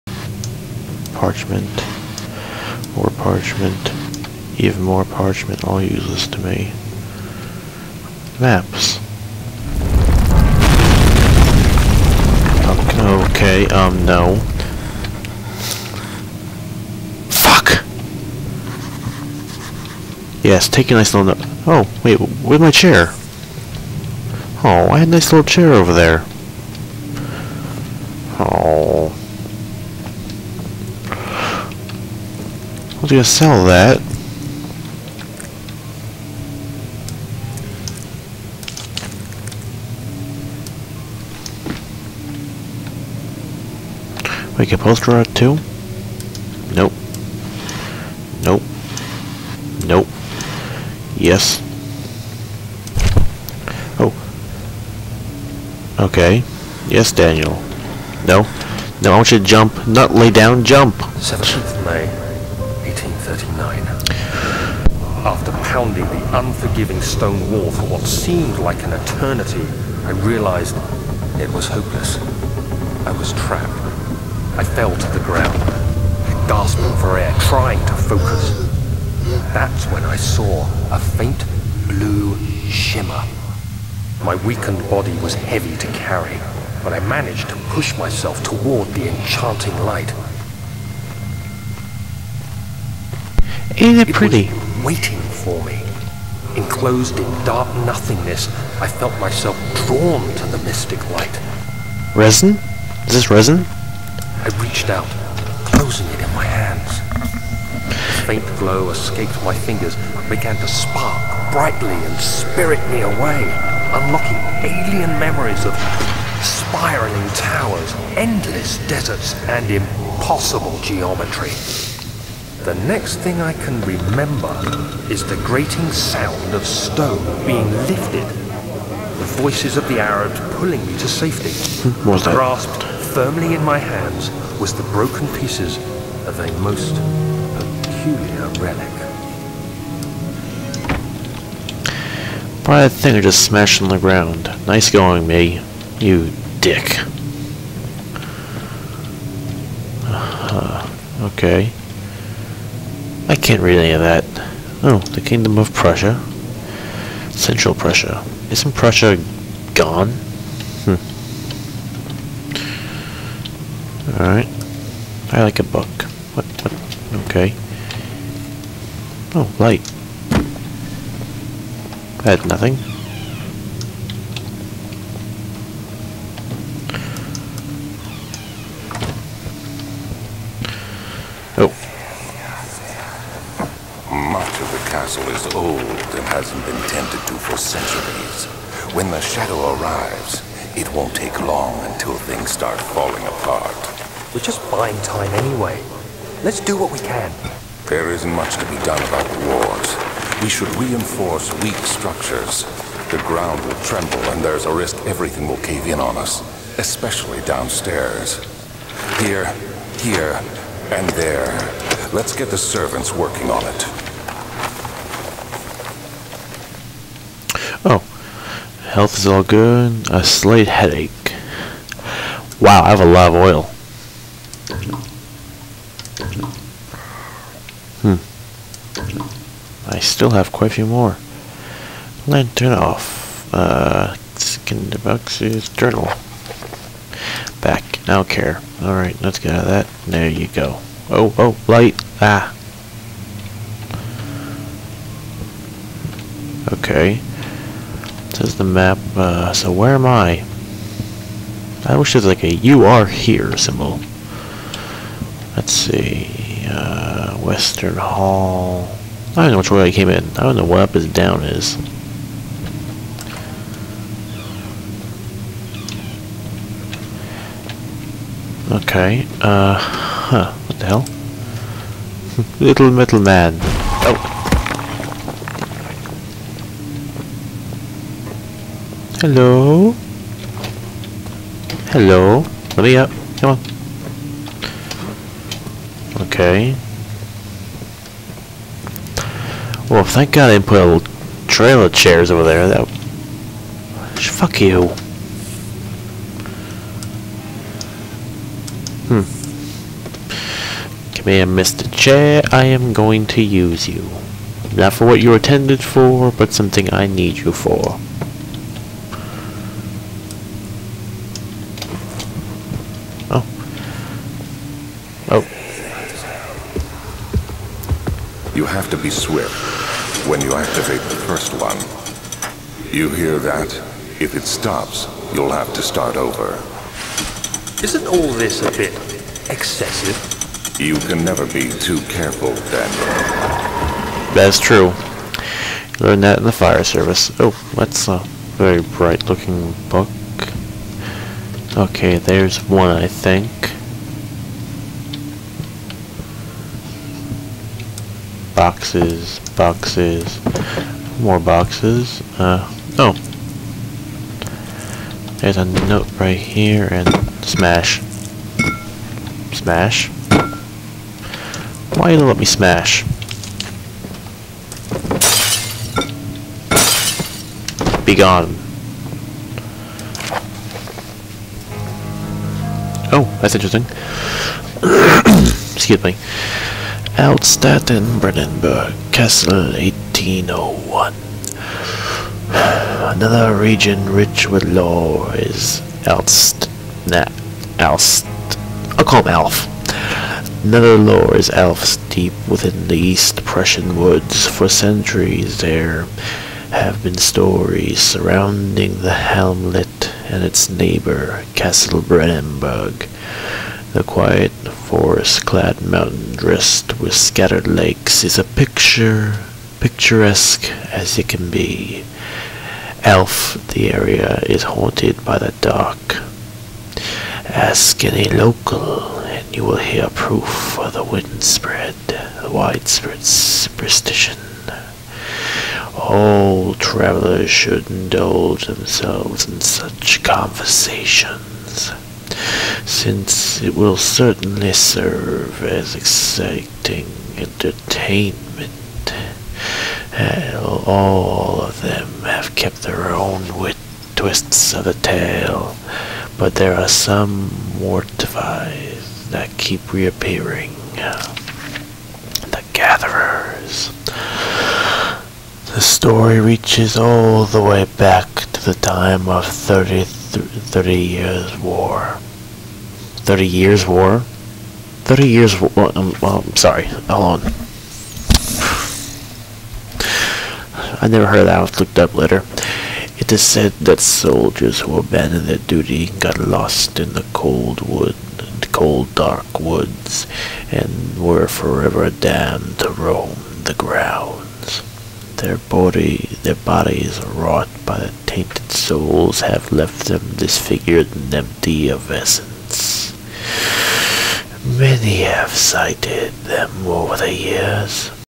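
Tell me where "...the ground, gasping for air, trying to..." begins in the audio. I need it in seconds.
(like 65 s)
75 s.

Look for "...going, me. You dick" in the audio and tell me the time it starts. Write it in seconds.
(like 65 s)
144 s.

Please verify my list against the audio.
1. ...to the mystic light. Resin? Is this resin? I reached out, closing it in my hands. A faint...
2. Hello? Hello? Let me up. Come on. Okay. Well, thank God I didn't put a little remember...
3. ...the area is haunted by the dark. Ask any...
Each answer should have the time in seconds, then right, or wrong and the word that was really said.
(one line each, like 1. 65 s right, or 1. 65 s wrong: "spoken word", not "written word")
1. 100 s right
2. 279 s wrong: "trailer", not "remember"
3. 413 s right.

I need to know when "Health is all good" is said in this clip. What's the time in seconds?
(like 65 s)
218 s.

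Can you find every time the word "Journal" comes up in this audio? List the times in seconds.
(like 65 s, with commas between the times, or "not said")
235 s.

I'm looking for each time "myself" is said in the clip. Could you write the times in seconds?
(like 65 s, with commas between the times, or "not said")
87 s, 99 s.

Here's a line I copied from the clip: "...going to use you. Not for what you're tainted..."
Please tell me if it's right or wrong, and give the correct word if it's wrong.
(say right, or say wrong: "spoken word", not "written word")
wrong: "intended", not "tainted".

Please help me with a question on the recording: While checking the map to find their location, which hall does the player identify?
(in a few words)
Western Hall.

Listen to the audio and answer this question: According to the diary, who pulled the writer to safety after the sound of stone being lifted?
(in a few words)
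The Arabs.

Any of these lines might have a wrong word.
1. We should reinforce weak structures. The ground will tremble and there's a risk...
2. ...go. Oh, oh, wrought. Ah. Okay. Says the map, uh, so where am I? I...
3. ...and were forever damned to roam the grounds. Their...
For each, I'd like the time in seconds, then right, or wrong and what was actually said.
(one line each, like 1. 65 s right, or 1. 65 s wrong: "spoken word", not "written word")
1. 200 s right
2. 240 s wrong: "light", not "wrought"
3. 480 s right.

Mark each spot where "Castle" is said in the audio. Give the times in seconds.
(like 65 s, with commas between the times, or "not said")
379 s, 401 s.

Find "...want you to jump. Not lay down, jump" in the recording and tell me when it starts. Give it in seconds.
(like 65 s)
59 s.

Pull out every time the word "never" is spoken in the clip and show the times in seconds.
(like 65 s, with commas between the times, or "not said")
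331 s, 471 s.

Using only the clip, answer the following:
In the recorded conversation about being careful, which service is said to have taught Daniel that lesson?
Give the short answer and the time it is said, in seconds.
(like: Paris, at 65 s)
The fire service, at 336 s.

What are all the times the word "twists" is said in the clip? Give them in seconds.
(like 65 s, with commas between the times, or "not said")
444 s.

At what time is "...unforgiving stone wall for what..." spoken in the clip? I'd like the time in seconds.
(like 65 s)
66 s.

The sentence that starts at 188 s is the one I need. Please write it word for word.
When the shadow arrives, it won't take long until things start falling apart.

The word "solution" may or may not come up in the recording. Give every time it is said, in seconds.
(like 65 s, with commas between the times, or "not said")
not said.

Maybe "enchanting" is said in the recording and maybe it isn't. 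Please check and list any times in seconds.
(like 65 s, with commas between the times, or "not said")
89 s.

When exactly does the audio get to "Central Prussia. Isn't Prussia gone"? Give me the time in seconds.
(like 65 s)
157 s.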